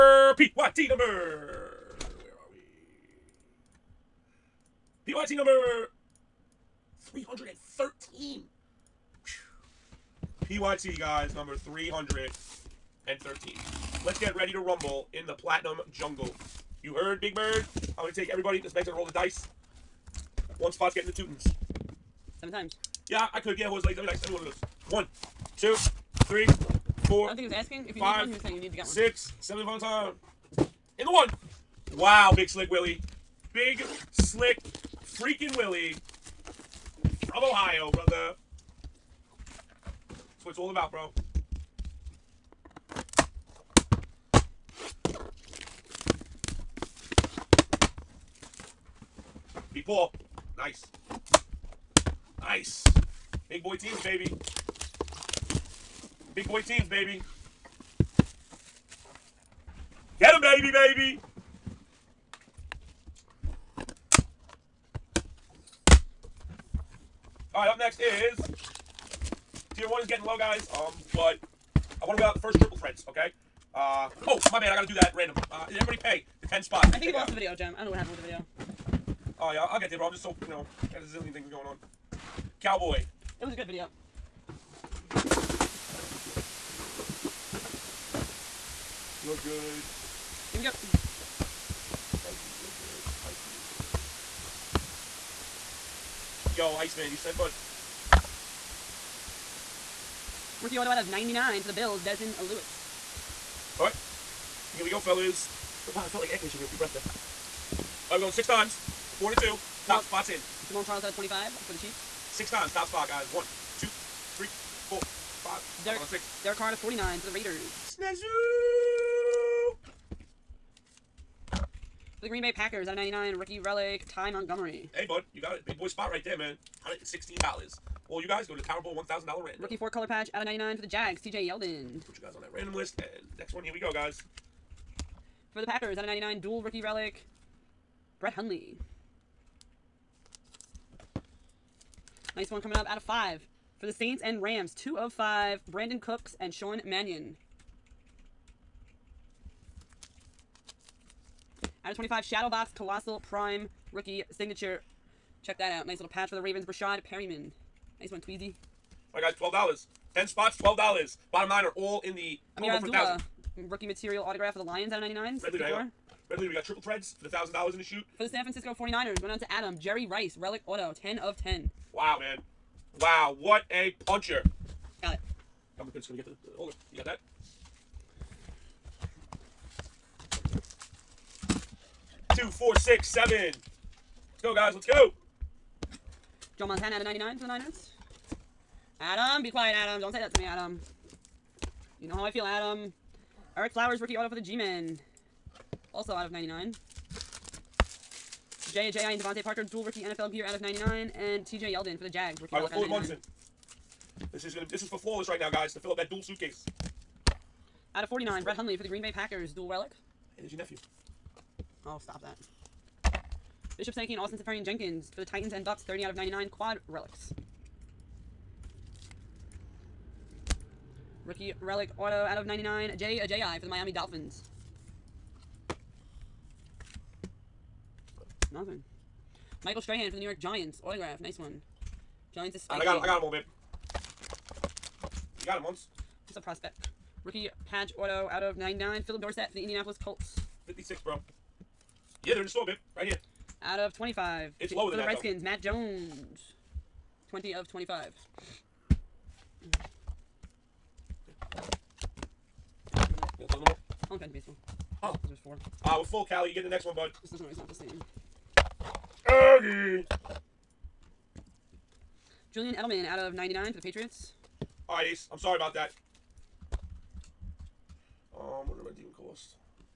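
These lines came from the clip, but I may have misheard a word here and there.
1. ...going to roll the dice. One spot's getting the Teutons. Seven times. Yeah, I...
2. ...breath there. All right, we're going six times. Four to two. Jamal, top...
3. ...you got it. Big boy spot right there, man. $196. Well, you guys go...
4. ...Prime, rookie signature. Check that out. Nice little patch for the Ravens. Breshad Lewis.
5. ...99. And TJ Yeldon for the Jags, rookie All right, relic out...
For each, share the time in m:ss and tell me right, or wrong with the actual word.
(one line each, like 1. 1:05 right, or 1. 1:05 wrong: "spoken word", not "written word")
1. 0:18 right
2. 1:46 right
3. 2:05 wrong: "116", not "196"
4. 2:33 wrong: "Perriman", not "Lewis"
5. 3:20 right.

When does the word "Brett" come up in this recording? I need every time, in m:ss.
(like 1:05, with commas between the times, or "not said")
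2:18, 3:28.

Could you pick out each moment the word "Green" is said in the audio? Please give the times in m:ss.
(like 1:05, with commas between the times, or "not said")
2:02, 3:28.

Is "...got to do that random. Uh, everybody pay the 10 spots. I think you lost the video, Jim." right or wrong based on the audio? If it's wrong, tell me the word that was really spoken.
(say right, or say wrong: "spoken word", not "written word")
right.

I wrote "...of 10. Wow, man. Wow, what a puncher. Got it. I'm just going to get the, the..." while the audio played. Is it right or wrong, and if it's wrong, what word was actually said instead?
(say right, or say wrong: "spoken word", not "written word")
right.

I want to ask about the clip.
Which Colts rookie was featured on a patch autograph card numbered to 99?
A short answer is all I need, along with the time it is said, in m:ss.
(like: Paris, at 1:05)
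Phillip Dorsett, at 3:59.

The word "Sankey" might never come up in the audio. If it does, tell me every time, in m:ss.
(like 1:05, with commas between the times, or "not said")
3:33.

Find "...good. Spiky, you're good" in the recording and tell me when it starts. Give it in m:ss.
1:32.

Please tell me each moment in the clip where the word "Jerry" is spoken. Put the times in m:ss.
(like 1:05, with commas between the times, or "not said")
2:49.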